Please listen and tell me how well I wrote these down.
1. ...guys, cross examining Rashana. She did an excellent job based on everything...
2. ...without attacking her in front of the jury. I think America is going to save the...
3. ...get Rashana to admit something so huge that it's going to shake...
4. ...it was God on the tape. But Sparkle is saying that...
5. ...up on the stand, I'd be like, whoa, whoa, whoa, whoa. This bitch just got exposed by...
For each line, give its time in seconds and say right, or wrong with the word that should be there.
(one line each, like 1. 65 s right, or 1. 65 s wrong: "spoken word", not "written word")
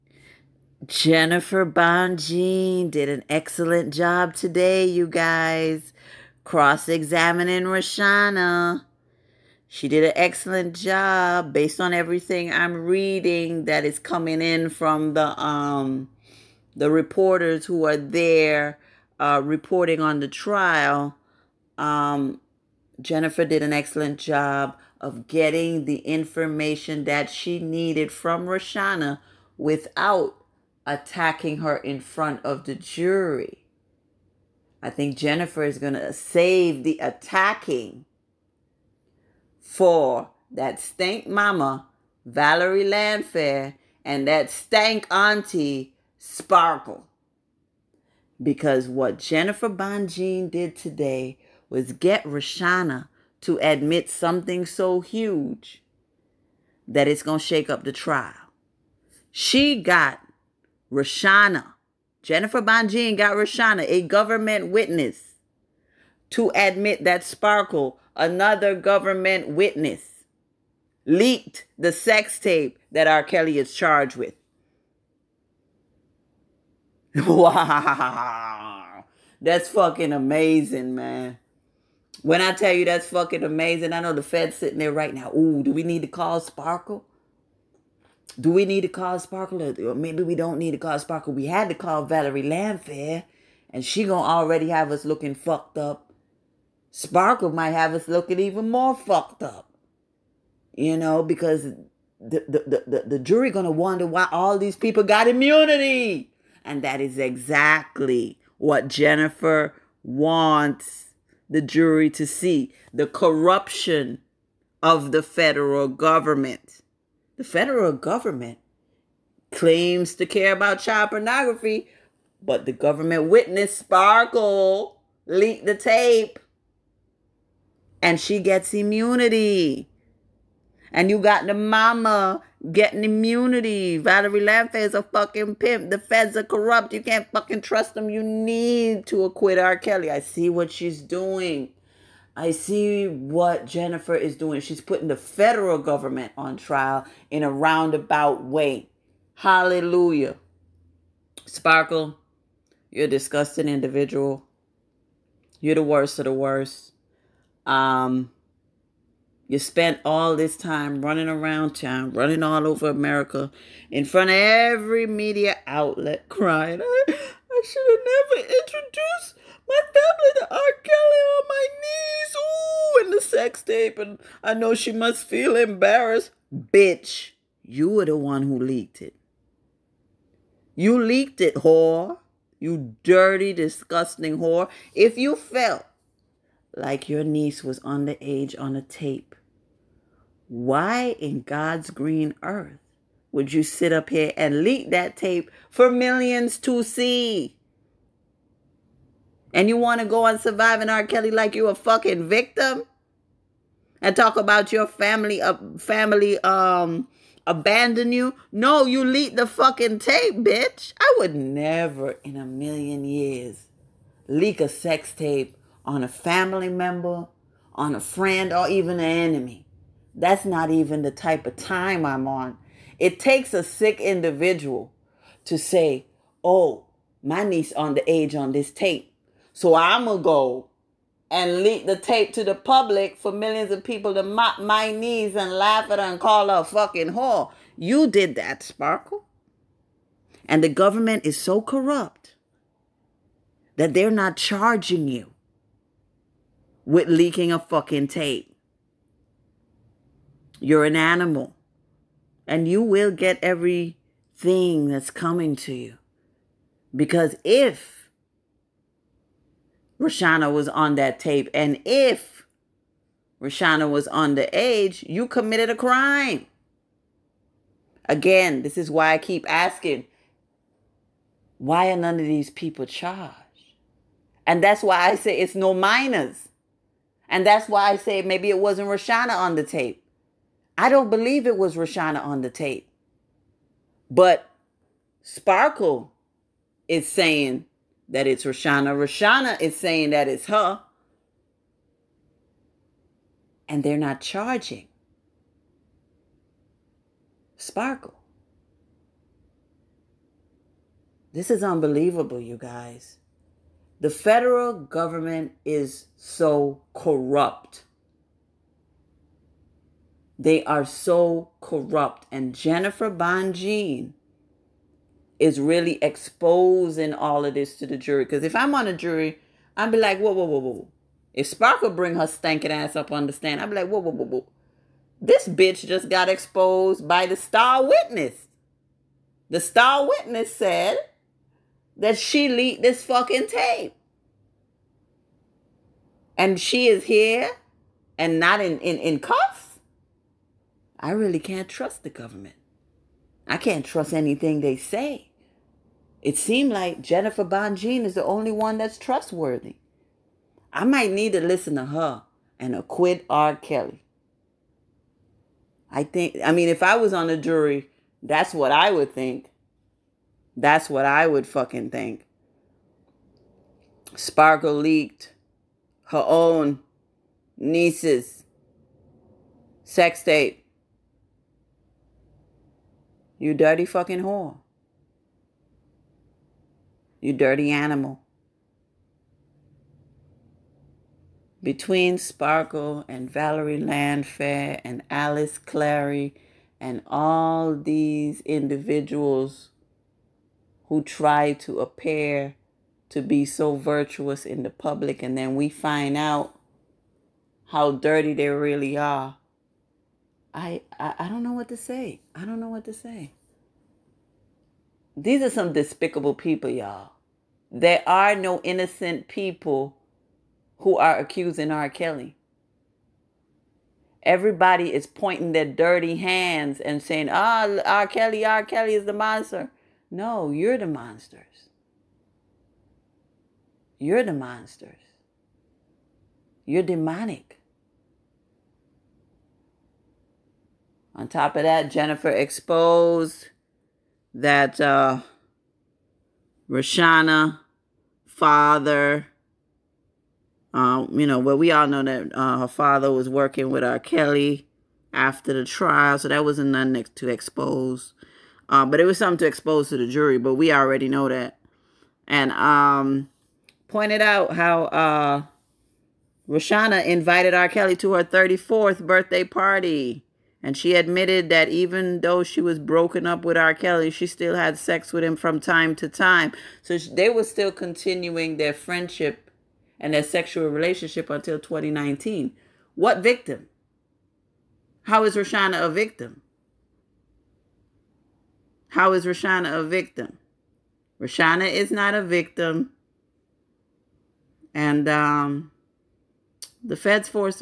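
1. 5 s right
2. 29 s wrong: "Jennifer", not "America"
3. 51 s right
4. 281 s wrong: "Rashana", not "God"
5. 322 s right.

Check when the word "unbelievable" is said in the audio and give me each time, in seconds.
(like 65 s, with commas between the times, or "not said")
301 s.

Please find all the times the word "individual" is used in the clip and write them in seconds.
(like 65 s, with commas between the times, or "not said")
153 s, 223 s, 388 s.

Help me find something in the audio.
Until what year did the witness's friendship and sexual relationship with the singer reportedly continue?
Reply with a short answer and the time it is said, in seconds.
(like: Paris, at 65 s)
2019, at 471 s.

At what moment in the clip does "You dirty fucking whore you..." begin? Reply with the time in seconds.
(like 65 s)
373 s.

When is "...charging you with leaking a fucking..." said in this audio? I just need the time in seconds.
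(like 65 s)
244 s.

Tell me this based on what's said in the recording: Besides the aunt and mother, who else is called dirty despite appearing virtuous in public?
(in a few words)
Alice Clary.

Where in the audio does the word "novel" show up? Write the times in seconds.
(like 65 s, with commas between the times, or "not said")
not said.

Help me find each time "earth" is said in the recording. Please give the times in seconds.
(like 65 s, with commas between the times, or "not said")
192 s.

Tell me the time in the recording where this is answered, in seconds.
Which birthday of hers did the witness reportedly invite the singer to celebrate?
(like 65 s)
458 s.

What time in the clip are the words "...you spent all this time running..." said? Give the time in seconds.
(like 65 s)
159 s.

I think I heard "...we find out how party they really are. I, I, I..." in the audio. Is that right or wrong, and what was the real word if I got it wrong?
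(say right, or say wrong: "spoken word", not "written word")
wrong: "dirty", not "party".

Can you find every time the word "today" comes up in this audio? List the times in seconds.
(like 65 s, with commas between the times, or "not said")
4 s, 50 s.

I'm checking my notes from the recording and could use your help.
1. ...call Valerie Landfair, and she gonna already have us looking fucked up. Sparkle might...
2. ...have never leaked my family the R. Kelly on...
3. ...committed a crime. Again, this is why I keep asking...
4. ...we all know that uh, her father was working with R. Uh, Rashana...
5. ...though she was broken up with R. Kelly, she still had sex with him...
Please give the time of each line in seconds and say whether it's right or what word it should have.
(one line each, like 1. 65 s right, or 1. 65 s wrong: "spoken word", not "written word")
1. 91 s right
2. 167 s wrong: "introduced", not "leaked"
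3. 265 s right
4. 441 s wrong: "Kelly", not "Rashana"
5. 462 s right.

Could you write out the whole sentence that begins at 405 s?
These are some despicable people, y'all.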